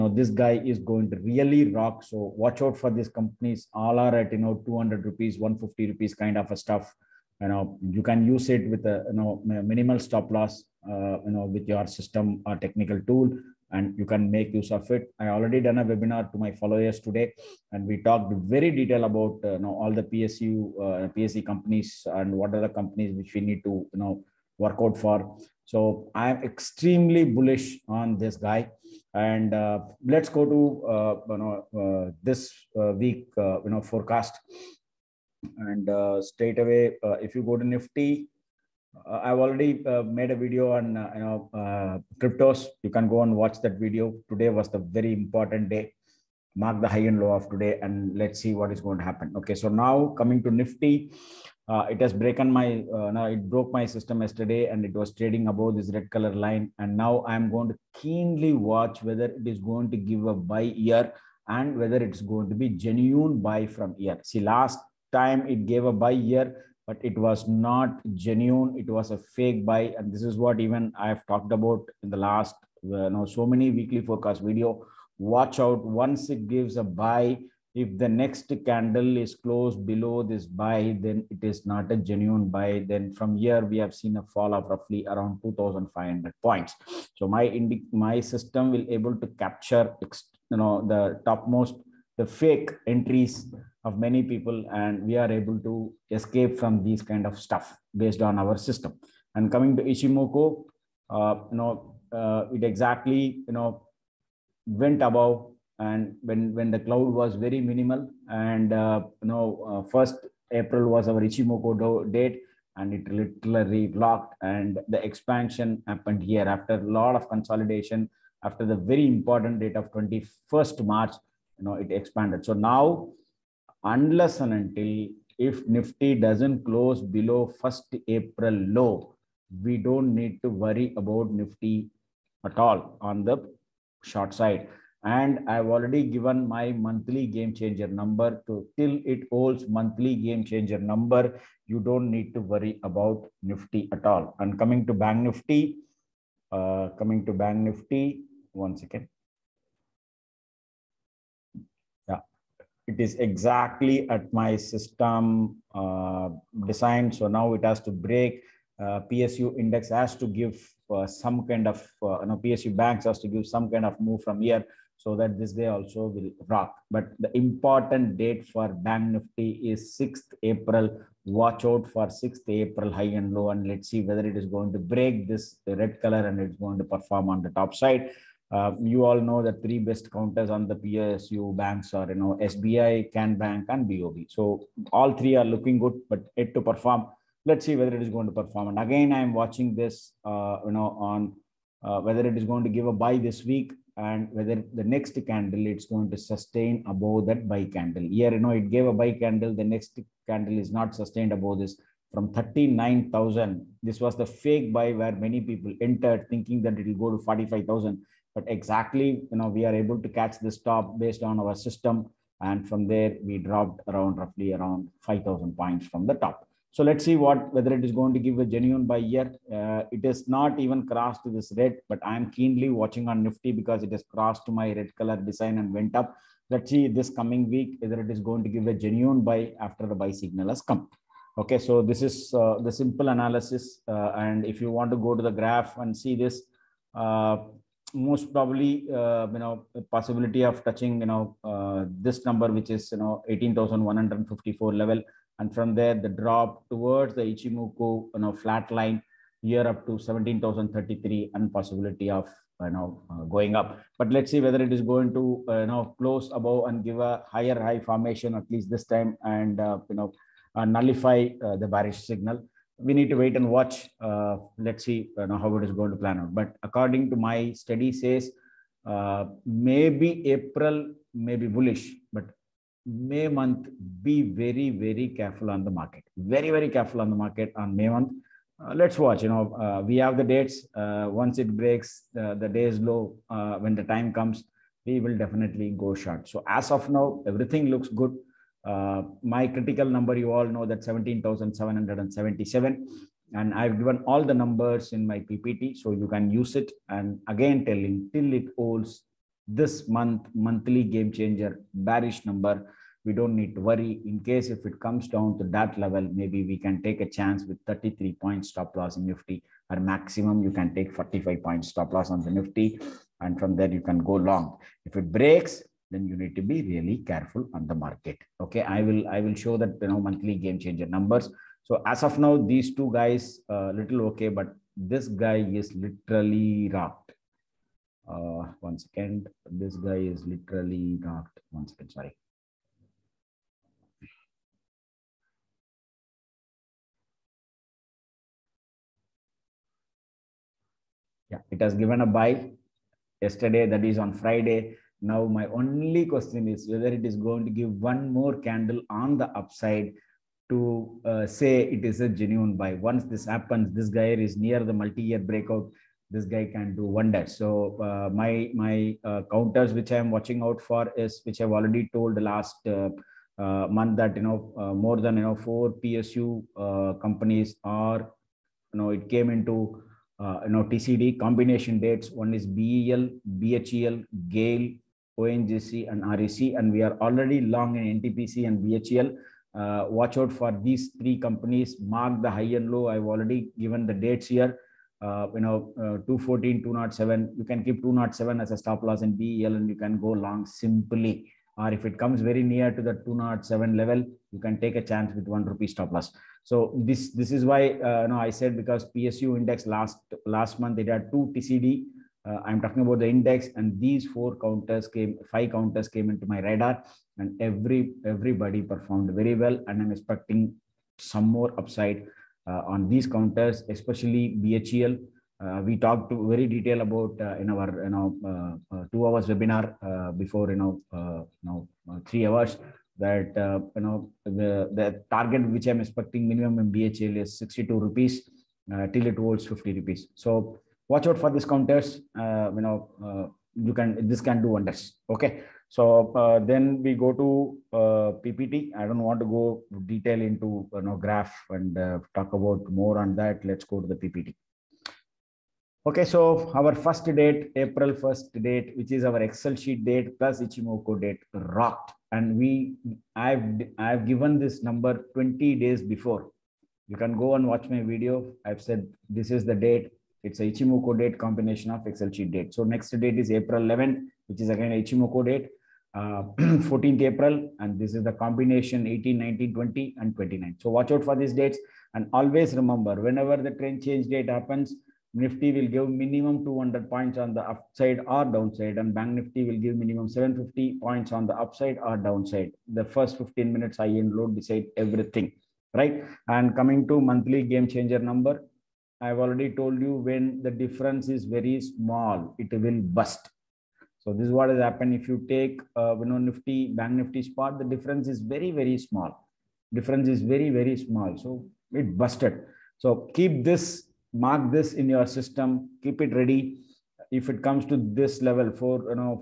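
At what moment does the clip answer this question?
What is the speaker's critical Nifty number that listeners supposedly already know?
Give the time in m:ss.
4:50.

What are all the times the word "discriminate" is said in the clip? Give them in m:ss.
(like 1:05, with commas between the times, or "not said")
not said.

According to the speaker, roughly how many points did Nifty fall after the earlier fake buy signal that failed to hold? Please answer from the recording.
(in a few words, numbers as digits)
2,500.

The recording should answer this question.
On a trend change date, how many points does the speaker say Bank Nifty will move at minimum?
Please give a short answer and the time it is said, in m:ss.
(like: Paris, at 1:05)
750, at 8:00.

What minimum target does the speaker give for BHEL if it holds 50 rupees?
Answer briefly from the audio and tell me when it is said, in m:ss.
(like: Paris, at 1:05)
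62 rupees, at 7:07.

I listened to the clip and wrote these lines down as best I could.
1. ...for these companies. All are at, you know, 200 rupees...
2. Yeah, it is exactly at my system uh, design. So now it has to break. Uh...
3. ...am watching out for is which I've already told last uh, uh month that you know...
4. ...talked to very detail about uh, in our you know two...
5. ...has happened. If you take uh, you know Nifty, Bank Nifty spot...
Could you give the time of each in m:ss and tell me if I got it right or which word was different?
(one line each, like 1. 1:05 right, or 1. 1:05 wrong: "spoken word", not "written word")
1. 0:02 right
2. 2:32 right
3. 6:00 right
4. 6:55 right
5. 8:14 right.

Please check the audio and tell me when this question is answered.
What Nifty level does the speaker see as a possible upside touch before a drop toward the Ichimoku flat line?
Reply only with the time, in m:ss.
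4:03.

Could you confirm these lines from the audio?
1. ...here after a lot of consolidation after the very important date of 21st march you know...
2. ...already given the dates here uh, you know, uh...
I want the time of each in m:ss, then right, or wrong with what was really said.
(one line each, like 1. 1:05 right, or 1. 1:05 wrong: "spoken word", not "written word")
1. 1:56 right
2. 6:23 right.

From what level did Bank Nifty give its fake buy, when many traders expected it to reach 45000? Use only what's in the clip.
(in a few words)
39000.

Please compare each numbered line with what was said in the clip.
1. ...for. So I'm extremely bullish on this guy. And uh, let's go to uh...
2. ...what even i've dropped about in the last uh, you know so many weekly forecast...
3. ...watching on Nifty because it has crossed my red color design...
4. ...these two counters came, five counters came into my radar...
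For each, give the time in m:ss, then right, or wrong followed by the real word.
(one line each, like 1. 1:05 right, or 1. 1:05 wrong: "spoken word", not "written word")
1. 0:24 right
2. 1:10 wrong: "talked", not "dropped"
3. 3:42 right
4. 6:43 wrong: "four", not "two".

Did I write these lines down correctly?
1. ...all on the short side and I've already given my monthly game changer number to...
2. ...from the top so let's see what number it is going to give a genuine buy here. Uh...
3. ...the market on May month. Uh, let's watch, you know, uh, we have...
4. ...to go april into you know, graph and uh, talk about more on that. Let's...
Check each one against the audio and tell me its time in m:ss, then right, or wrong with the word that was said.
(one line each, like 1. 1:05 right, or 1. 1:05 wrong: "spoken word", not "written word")
1. 2:12 right
2. 3:35 wrong: "whether", not "number"
3. 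4:37 right
4. 7:19 wrong: "detail", not "april".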